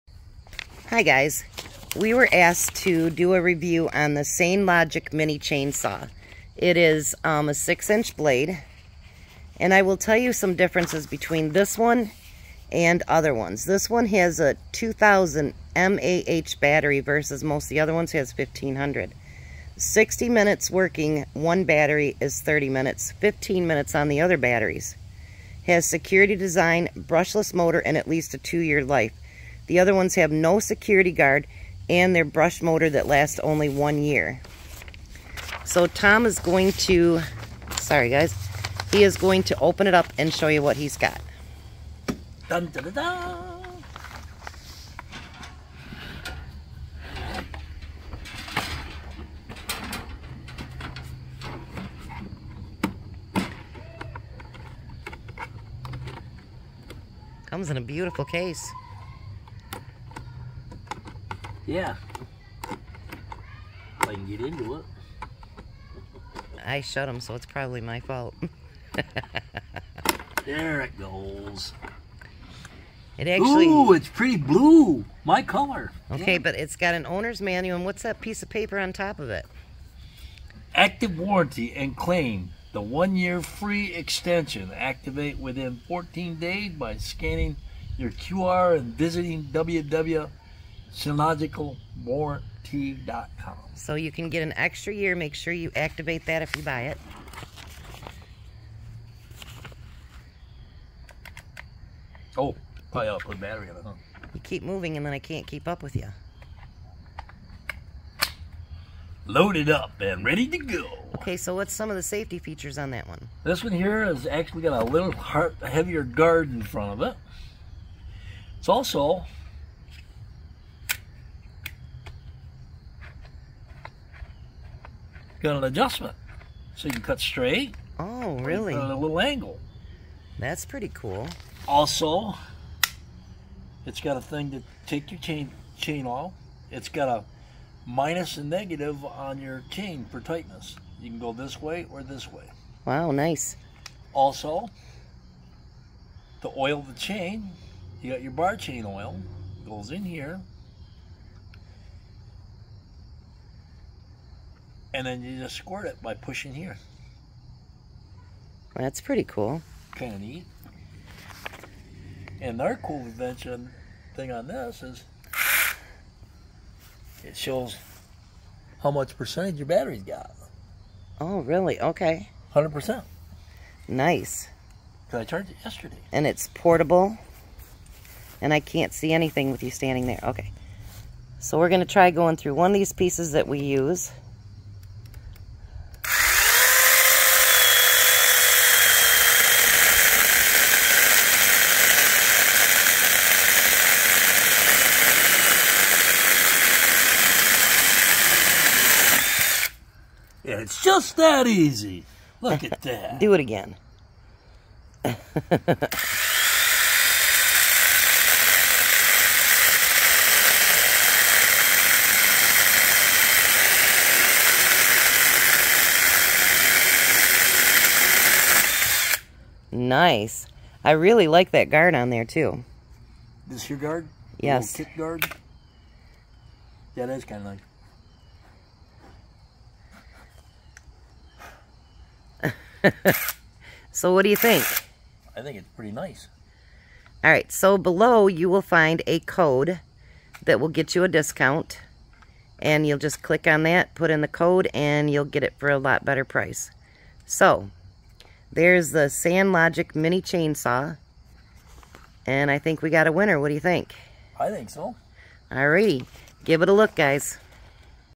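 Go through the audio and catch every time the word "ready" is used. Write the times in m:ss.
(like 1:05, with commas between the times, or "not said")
1:50.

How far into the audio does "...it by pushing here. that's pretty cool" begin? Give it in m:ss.
2:35.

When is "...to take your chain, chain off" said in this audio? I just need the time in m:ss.
2:14.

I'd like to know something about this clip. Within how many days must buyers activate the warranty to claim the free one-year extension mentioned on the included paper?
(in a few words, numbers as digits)
14 days.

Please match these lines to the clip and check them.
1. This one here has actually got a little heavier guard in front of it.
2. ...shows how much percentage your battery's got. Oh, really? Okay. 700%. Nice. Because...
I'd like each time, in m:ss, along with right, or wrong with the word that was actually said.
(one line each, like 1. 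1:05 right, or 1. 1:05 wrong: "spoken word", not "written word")
1. 1:53 right
2. 2:47 wrong: "100", not "700".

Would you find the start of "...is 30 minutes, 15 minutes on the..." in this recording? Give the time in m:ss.
0:22.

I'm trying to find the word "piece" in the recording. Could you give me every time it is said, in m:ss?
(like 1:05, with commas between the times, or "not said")
1:18, 3:02.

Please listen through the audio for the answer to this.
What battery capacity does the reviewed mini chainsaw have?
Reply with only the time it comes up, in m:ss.
0:14.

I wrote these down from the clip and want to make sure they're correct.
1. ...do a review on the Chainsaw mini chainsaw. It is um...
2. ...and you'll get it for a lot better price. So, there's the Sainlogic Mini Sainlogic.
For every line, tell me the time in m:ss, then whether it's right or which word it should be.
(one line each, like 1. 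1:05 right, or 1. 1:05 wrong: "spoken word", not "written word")
1. 0:03 wrong: "Sainlogic", not "Chainsaw"
2. 4:04 wrong: "Chainsaw", not "Sainlogic".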